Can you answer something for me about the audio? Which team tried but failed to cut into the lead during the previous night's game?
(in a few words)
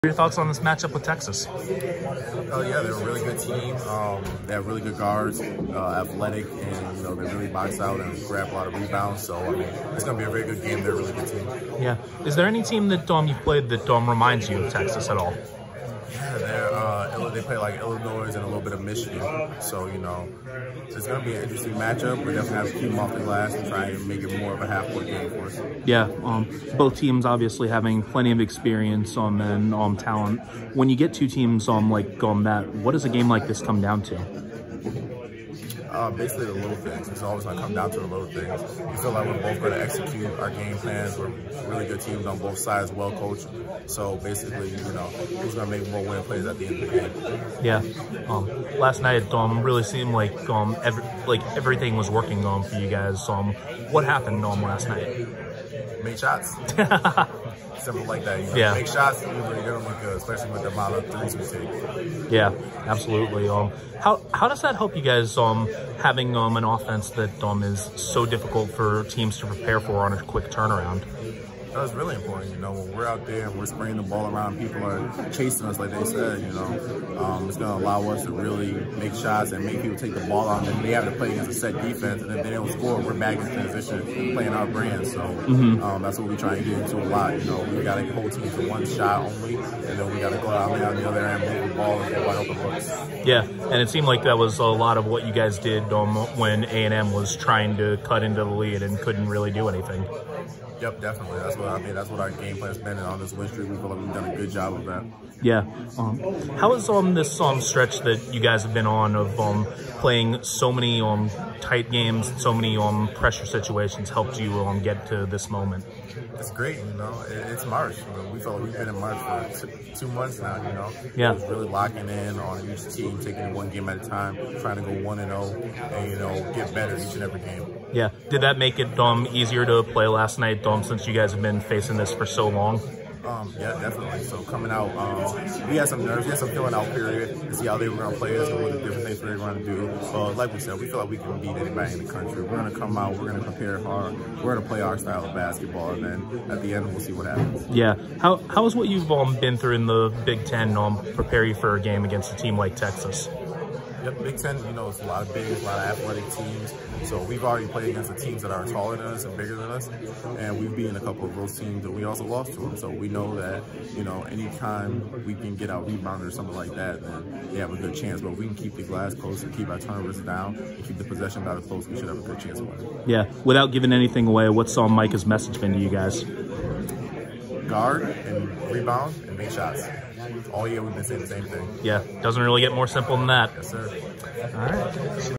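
A and M.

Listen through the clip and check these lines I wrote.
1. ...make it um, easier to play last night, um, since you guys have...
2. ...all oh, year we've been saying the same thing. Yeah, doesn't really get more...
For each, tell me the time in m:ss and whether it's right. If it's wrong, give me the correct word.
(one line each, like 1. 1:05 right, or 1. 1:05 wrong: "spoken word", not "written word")
1. 2:08 right
2. 3:00 right.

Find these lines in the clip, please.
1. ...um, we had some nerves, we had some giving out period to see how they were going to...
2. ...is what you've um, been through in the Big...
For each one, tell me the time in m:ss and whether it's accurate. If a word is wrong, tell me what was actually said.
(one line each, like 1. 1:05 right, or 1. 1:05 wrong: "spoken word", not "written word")
1. 2:14 wrong: "feeling", not "giving"
2. 2:28 right.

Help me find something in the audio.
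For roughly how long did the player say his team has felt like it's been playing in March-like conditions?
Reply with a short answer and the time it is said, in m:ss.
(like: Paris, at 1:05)
2 months, at 1:59.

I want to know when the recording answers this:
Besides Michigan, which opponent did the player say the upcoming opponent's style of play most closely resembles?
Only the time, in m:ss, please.
0:17.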